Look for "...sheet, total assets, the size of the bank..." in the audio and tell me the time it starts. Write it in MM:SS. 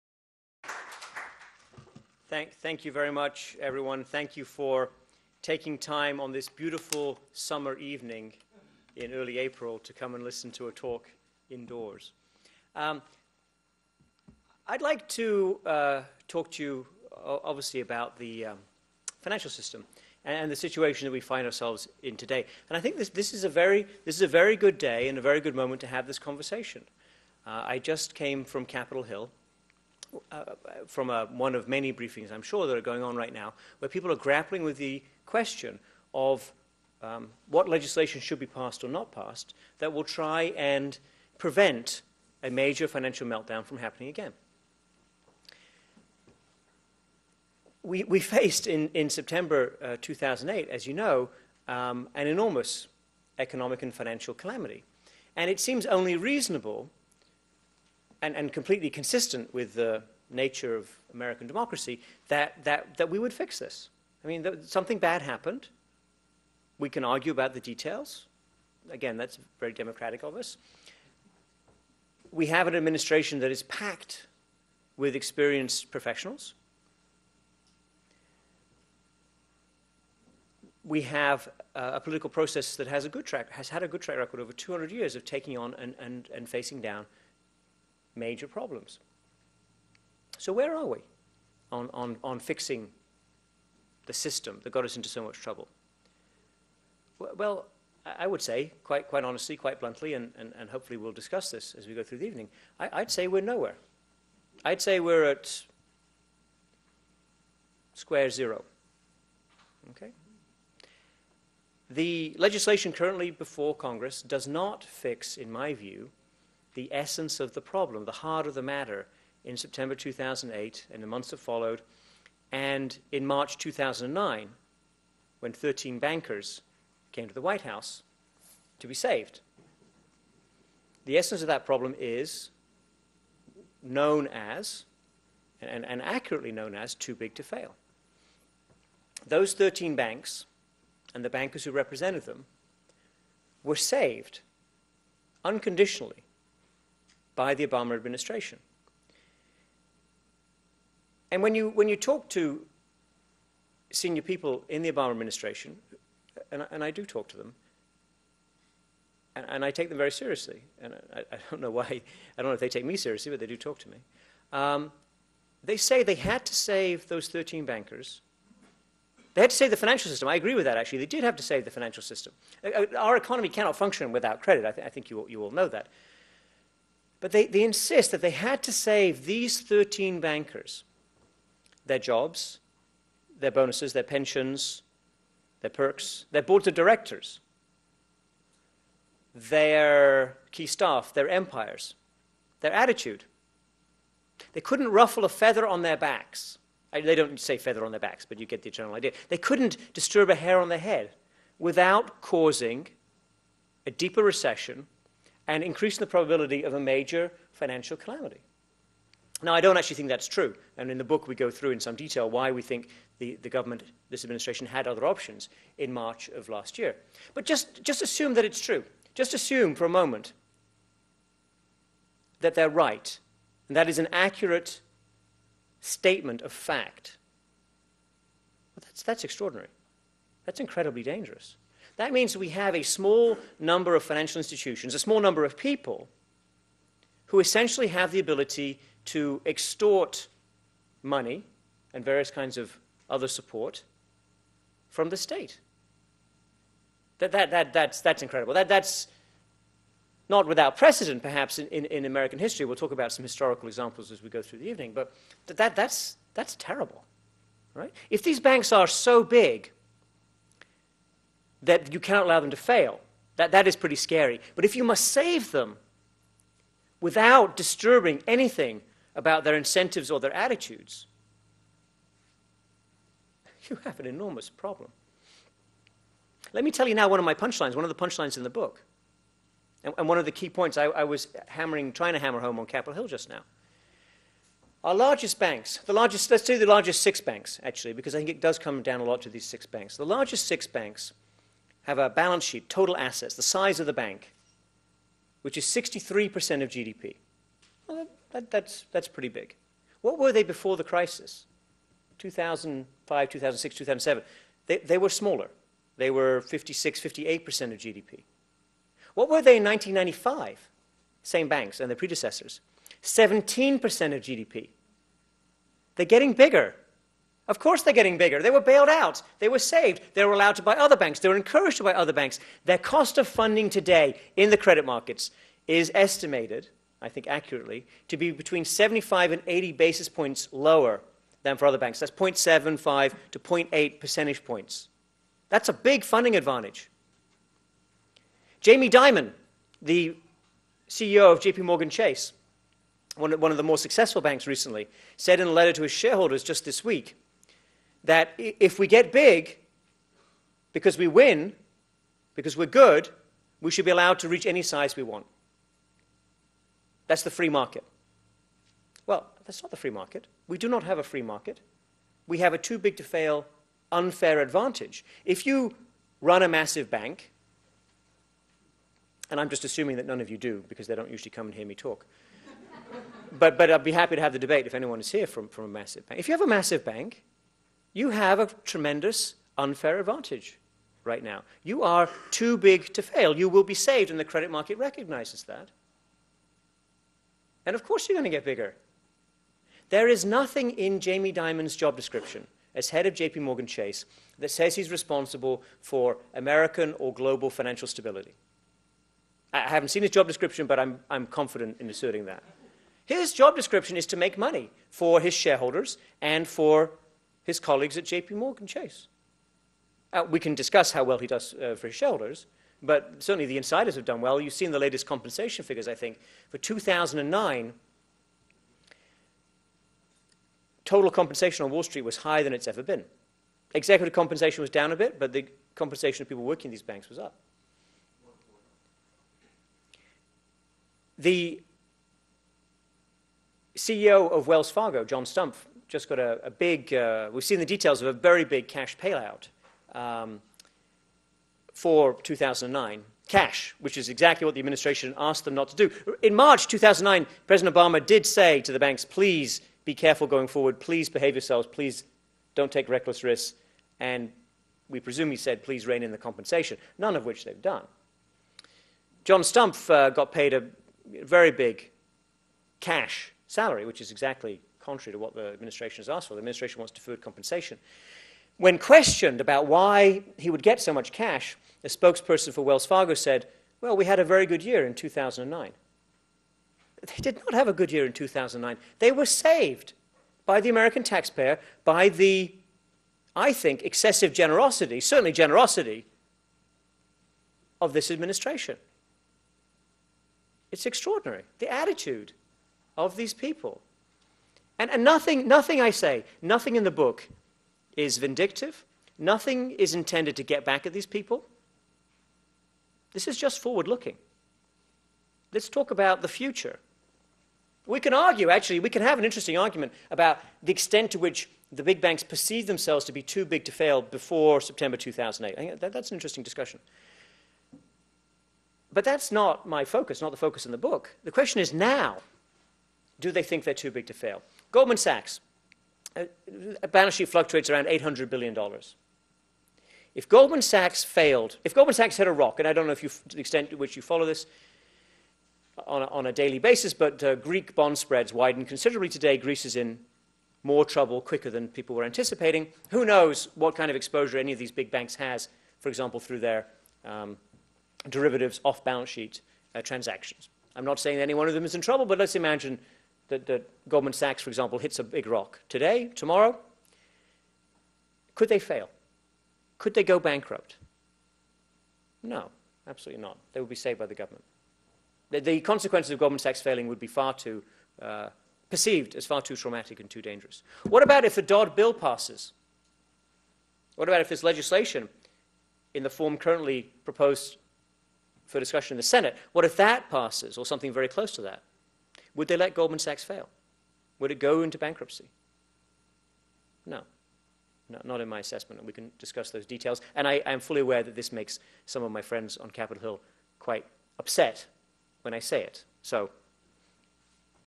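04:52.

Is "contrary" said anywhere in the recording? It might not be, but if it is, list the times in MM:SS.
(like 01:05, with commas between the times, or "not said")
07:44.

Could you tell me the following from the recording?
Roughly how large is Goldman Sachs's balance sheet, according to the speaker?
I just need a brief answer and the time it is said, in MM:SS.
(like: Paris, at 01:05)
$800 billion, at 08:47.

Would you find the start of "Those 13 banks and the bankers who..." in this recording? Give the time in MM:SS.
02:19.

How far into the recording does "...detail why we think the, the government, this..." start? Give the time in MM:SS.
03:31.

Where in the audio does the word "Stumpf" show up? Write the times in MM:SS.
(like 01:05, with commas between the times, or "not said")
07:15, 07:39.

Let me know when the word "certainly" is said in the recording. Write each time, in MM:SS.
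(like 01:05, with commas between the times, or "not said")
06:53, 08:04.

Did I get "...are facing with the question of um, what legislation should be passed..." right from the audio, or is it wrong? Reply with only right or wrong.
wrong.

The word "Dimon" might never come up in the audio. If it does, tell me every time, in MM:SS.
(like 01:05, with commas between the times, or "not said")
05:38, 06:31.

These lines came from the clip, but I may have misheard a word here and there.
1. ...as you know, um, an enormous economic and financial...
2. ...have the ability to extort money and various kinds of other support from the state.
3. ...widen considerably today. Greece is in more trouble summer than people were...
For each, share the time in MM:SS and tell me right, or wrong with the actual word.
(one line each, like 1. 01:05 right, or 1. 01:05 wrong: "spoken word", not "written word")
1. 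00:50 right
2. 03:57 right
3. 08:58 wrong: "quicker", not "summer".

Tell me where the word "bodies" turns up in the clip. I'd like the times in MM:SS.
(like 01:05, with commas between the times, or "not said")
not said.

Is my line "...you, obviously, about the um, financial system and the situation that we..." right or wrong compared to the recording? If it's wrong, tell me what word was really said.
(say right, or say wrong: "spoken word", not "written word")
right.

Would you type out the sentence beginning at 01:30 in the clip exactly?
So where are we on, on, on fixing the system that got us into so much trouble?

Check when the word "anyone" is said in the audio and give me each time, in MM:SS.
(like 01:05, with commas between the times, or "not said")
06:14.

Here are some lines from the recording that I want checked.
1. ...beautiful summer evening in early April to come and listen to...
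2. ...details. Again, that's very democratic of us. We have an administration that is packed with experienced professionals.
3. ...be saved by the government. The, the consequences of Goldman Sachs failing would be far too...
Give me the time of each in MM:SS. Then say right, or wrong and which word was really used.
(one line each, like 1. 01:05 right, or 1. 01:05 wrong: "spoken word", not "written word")
1. 00:06 right
2. 01:07 right
3. 09:23 right.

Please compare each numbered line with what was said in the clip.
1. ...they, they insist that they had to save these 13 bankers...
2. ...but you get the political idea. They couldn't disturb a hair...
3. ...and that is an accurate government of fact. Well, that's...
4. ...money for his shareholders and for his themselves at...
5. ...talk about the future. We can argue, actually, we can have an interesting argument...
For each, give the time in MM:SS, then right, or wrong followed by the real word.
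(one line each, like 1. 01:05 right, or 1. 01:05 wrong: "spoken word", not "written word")
1. 02:57 right
2. 03:18 wrong: "general", not "political"
3. 03:43 wrong: "statement", not "government"
4. 06:44 wrong: "colleagues", not "themselves"
5. 08:25 right.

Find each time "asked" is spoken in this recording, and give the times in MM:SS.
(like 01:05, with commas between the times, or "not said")
07:25, 07:46.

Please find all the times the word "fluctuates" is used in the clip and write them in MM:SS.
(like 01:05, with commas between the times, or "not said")
08:47.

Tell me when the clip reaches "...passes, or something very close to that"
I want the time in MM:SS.
09:40.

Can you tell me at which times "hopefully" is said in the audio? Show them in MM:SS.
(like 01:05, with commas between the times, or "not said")
01:40.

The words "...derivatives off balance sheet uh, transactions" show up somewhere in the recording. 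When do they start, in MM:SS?
09:08.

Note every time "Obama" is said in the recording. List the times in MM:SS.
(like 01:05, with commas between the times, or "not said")
02:27, 02:34, 07:27.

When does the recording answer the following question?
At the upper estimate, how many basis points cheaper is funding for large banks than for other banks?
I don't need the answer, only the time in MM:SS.
05:29.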